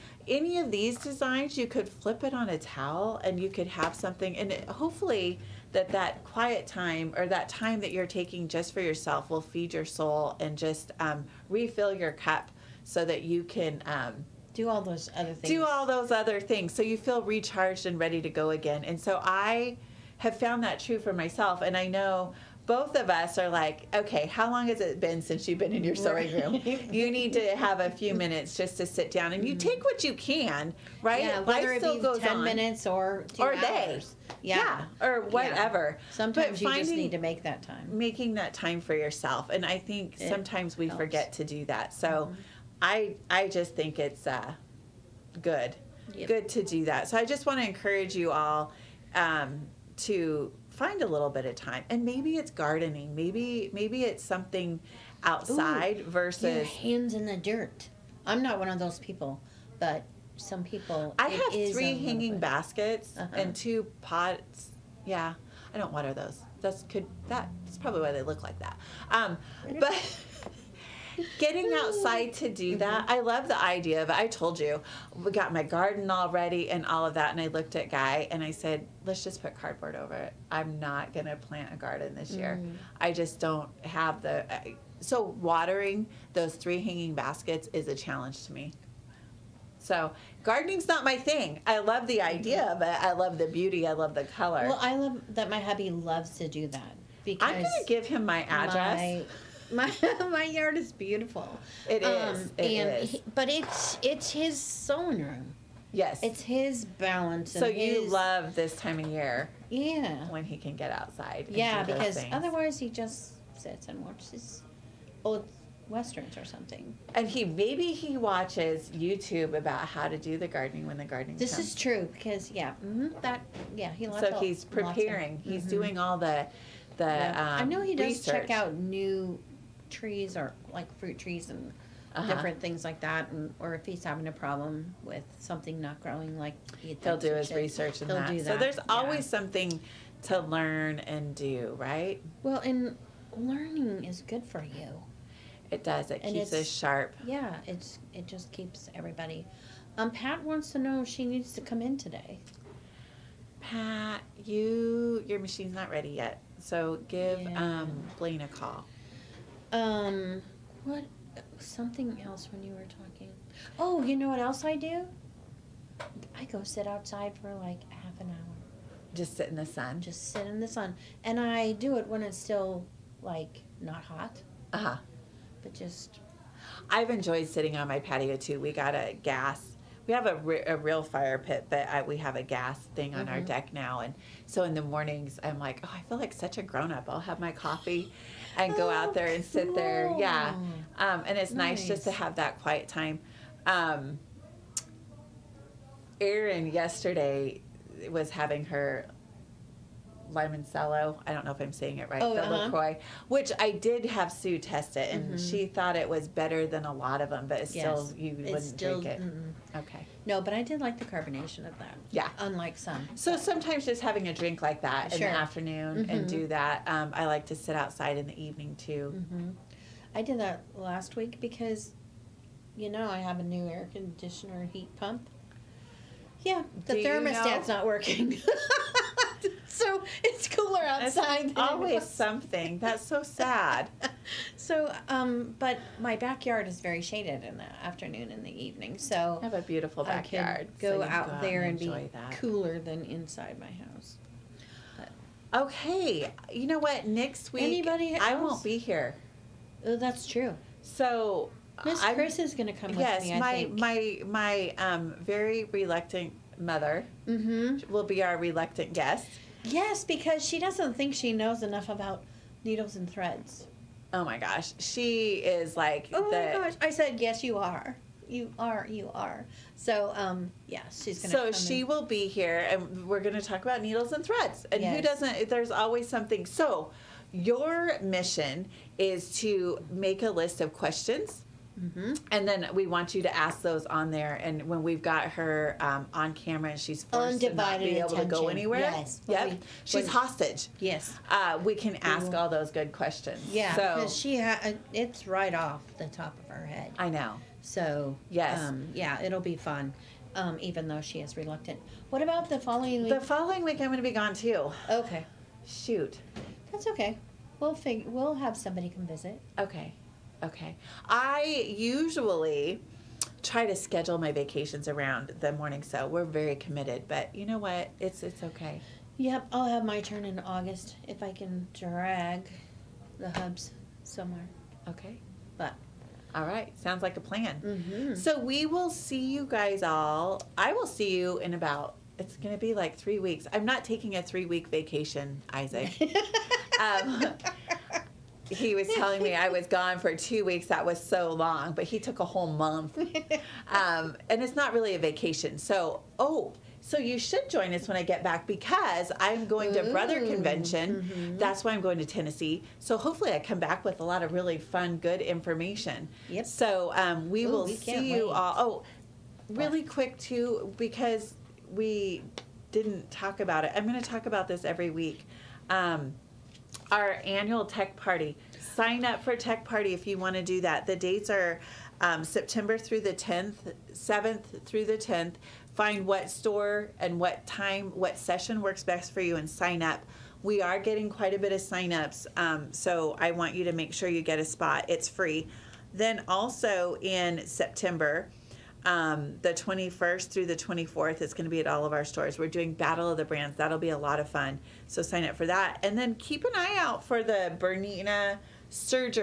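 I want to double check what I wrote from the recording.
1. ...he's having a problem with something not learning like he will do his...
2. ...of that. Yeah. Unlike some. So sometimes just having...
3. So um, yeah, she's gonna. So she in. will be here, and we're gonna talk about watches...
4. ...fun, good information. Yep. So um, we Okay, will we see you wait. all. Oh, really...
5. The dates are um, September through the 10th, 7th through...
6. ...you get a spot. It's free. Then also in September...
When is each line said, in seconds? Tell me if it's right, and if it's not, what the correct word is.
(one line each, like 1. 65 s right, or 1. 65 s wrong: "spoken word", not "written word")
1. 133 s wrong: "growing", not "learning"
2. 211 s right
3. 269 s wrong: "needles", not "watches"
4. 354 s wrong: "Ooh", not "Okay"
5. 370 s right
6. 384 s right.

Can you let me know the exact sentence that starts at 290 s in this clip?
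Yes, uh, we can ask all those good questions.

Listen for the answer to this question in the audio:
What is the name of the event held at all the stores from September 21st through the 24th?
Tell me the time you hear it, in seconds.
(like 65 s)
392 s.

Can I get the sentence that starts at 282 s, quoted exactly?
And then we want you to ask those on there.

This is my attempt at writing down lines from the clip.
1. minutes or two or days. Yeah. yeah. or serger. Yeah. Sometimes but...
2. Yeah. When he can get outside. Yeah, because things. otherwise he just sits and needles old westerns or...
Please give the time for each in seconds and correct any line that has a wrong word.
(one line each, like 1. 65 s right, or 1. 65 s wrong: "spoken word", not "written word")
1. 32 s wrong: "whatever", not "serger"
2. 109 s wrong: "watches", not "needles".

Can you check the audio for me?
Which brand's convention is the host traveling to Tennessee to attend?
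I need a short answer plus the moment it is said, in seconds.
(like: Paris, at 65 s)
Brother, at 349 s.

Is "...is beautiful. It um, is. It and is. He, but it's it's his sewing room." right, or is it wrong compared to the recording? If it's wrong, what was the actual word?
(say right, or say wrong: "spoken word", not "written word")
right.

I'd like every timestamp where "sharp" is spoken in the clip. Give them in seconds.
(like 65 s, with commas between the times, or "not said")
146 s.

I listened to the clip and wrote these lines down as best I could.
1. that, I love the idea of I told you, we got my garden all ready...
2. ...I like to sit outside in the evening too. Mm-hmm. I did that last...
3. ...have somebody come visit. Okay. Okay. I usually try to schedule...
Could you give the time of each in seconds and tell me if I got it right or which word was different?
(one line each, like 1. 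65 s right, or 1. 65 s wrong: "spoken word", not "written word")
1. 72 s right
2. 217 s right
3. 308 s right.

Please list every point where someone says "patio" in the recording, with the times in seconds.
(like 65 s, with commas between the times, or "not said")
177 s.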